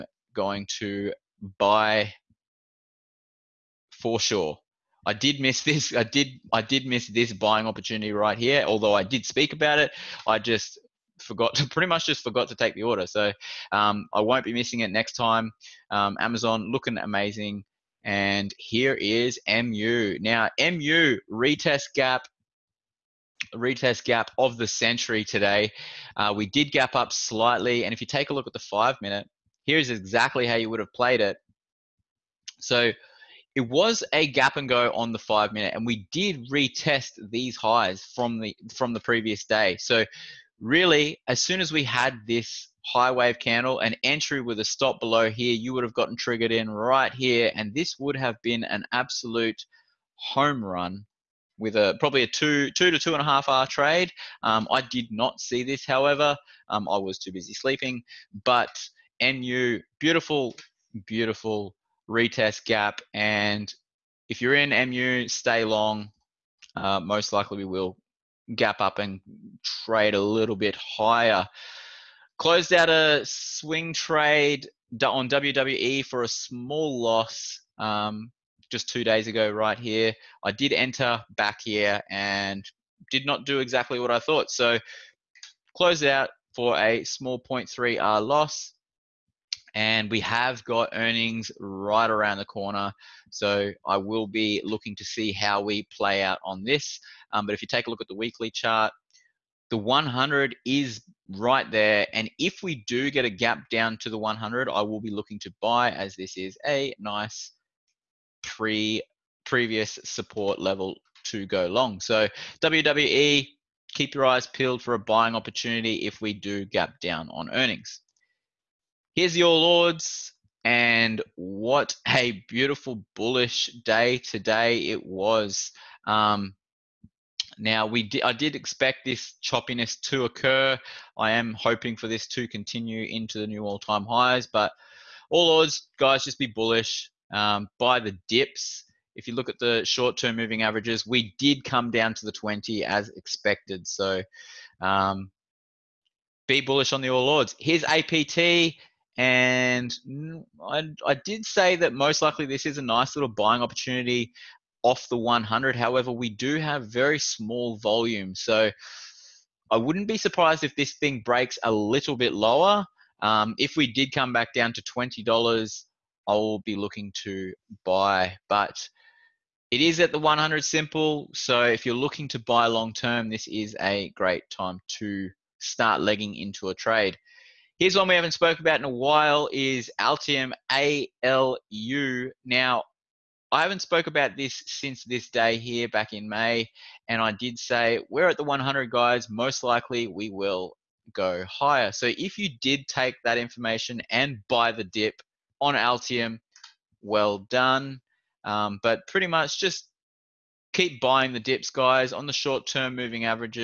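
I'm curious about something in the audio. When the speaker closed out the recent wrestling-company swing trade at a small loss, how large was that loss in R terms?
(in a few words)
0.3R.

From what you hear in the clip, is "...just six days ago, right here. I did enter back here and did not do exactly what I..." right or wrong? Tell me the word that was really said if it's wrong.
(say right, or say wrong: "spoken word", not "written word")
wrong: "two", not "six".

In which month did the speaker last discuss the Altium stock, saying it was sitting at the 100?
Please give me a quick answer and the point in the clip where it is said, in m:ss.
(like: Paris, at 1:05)
May, at 3:06.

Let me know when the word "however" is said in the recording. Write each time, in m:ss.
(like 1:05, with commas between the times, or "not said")
0:55, 2:35.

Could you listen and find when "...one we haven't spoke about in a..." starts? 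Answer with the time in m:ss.
2:57.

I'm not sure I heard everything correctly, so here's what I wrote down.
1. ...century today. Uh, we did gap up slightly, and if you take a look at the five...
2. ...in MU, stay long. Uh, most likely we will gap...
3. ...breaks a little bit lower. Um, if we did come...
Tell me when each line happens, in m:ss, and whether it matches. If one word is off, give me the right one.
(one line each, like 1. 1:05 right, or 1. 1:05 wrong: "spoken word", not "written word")
1. 0:24 right
2. 1:04 right
3. 2:41 right.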